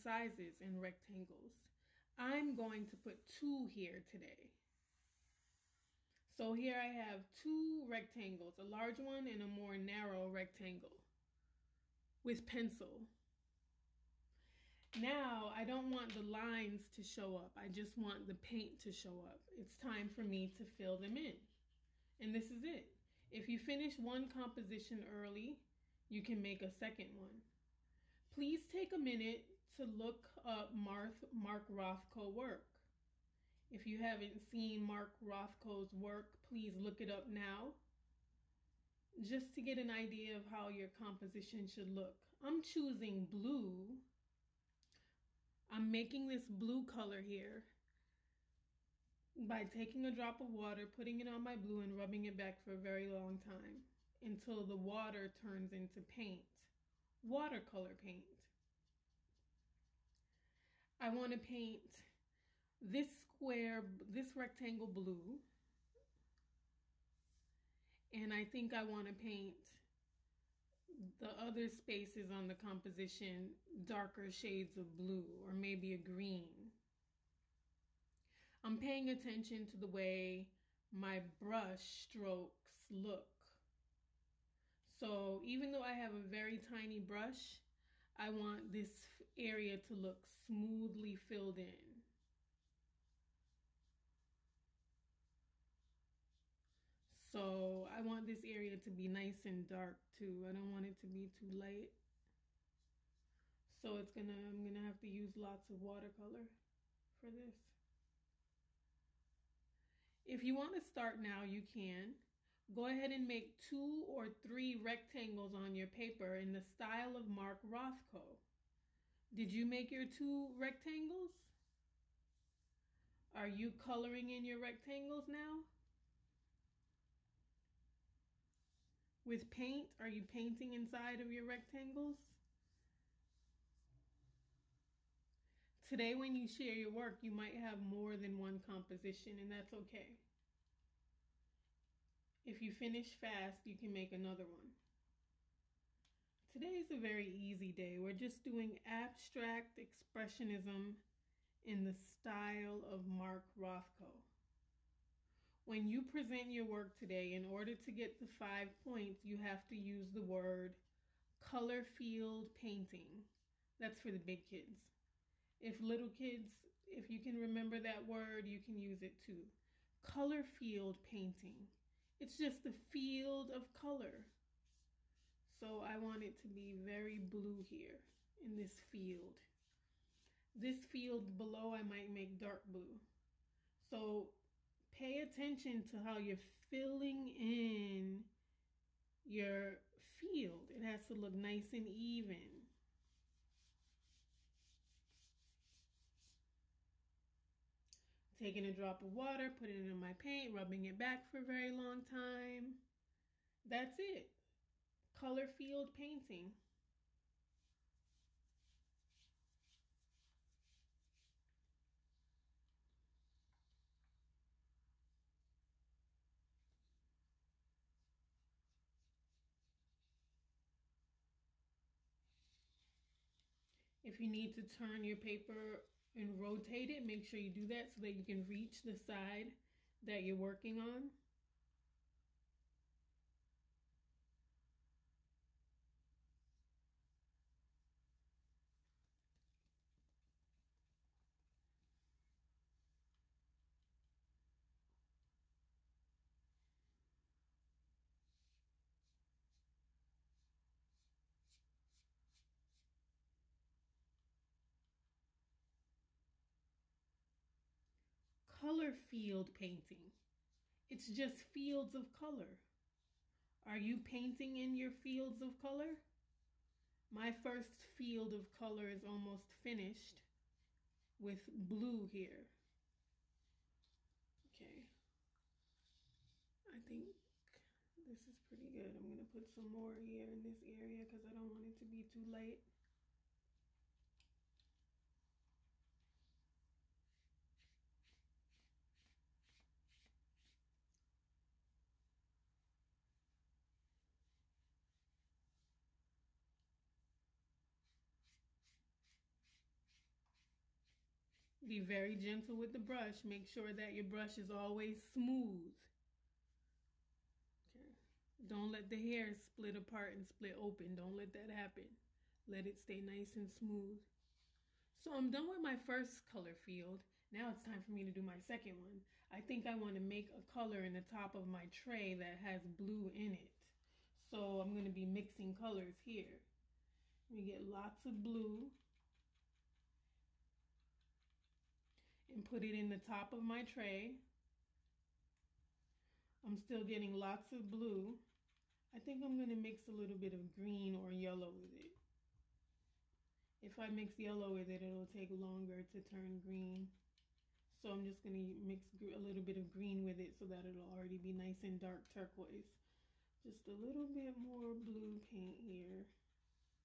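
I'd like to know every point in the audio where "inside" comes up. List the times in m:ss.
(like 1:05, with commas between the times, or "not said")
2:10.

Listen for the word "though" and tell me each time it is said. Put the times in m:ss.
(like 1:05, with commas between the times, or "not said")
1:25.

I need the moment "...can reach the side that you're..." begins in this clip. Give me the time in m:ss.
3:48.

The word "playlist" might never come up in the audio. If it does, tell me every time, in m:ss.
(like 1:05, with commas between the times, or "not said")
not said.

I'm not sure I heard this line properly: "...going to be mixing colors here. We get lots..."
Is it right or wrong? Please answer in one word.
right.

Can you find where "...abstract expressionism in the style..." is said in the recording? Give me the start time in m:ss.
2:28.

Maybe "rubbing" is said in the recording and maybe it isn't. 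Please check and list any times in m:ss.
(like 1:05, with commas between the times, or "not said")
0:51, 3:20.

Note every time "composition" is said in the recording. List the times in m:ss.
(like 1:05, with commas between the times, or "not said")
0:24, 0:40, 1:12, 2:18.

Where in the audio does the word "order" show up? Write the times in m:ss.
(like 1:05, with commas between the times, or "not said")
2:37.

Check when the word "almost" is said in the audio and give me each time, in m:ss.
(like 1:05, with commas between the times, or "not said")
4:29.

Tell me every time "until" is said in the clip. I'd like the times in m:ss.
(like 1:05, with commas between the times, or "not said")
0:54.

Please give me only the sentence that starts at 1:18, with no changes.
I'm paying attention to the way my brush strokes look.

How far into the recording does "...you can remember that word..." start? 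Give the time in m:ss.
2:47.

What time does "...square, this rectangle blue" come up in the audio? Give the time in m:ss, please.
1:03.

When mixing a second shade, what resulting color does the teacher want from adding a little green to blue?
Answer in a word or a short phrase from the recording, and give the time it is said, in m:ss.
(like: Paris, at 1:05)
Dark turquoise, at 5:51.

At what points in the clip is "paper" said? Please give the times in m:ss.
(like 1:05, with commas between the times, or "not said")
1:55, 3:45.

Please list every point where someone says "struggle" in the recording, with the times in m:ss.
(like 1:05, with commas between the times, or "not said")
not said.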